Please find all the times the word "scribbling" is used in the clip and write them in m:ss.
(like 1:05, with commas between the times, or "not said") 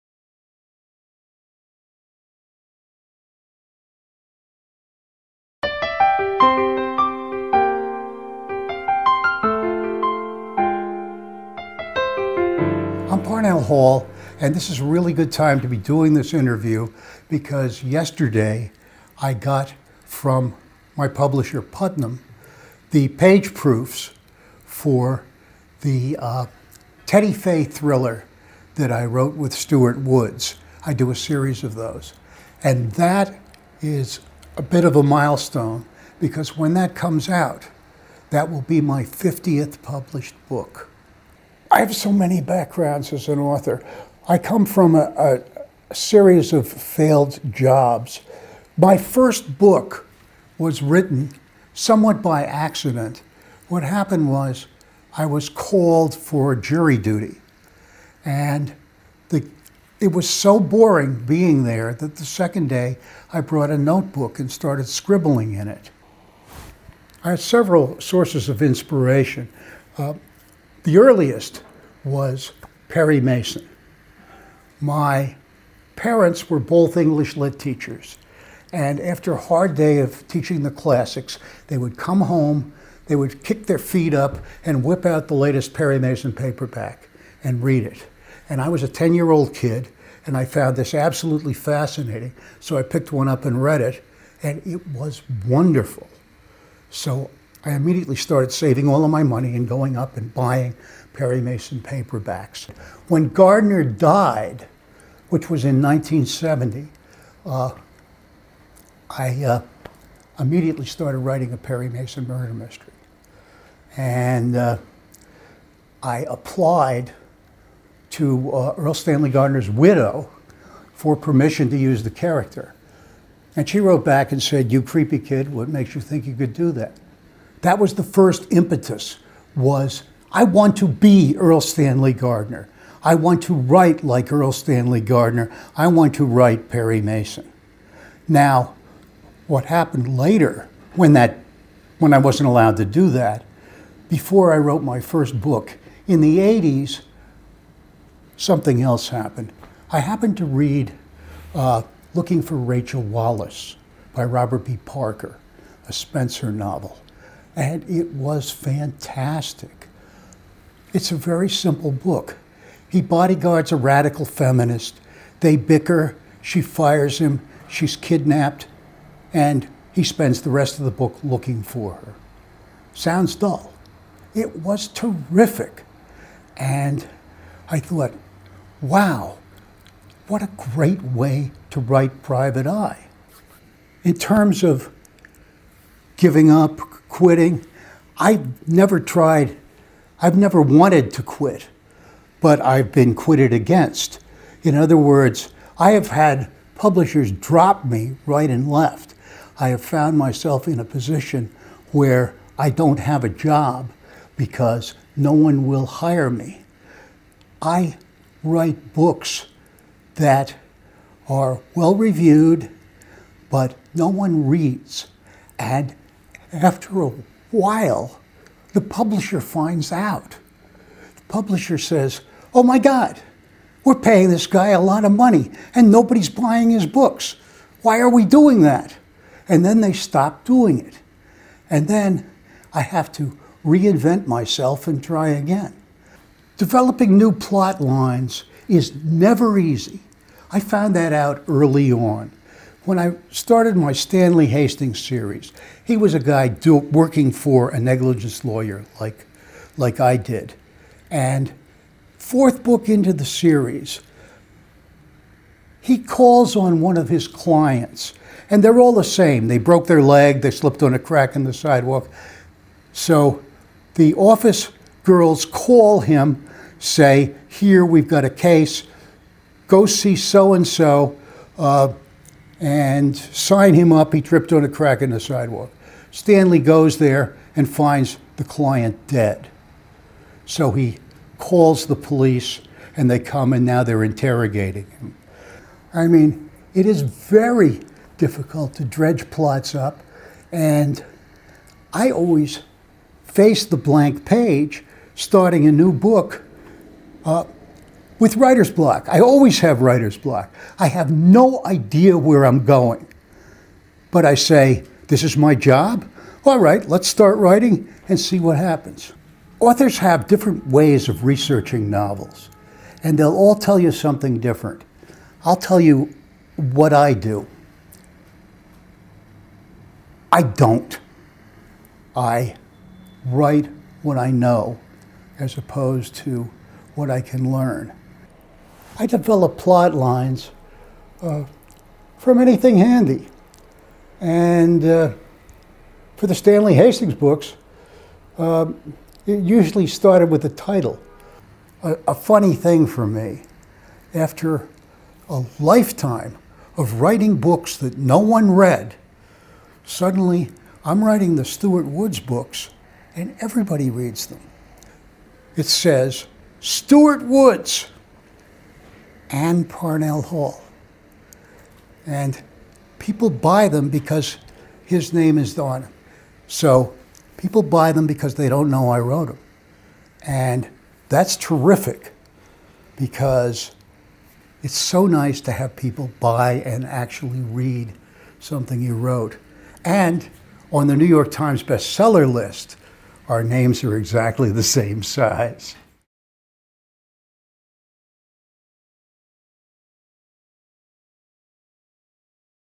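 1:04.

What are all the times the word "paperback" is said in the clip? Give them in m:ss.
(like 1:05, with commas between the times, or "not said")
1:26, 1:41.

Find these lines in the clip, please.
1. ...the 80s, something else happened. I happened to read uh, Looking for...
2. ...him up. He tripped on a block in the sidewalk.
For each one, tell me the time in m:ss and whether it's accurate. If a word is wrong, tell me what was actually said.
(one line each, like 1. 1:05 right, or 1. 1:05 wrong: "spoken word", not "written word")
1. 2:26 right
2. 4:33 wrong: "crack", not "block".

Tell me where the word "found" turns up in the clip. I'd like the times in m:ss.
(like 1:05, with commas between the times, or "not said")
1:30, 3:19, 4:00.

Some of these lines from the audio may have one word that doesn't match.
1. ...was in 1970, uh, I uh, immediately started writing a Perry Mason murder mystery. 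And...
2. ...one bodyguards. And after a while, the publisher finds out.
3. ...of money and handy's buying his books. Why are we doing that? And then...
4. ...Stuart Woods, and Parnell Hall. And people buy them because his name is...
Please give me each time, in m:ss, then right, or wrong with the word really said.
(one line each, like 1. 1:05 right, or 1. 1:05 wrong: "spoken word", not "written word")
1. 1:45 right
2. 3:34 wrong: "reads", not "bodyguards"
3. 3:45 wrong: "nobody", not "handy"
4. 5:56 right.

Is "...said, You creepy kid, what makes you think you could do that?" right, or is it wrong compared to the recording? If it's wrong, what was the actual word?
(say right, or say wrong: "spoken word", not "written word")
right.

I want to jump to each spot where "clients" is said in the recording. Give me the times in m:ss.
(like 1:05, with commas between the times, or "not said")
4:17, 4:38.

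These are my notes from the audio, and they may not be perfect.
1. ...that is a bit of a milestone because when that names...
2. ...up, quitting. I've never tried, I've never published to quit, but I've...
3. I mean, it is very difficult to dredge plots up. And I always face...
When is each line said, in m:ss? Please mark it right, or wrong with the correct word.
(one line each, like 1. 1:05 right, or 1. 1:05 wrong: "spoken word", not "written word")
1. 0:32 wrong: "comes", not "names"
2. 3:06 wrong: "wanted", not "published"
3. 4:45 right.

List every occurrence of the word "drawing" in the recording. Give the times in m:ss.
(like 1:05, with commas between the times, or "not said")
not said.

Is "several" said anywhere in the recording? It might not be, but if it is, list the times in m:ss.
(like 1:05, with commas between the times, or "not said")
1:07.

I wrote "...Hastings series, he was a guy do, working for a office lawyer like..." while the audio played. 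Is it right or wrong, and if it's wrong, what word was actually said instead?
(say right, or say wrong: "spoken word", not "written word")
wrong: "negligence", not "office".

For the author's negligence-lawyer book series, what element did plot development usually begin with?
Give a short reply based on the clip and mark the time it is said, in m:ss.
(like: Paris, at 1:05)
the title, at 5:40.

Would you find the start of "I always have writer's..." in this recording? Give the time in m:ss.
4:59.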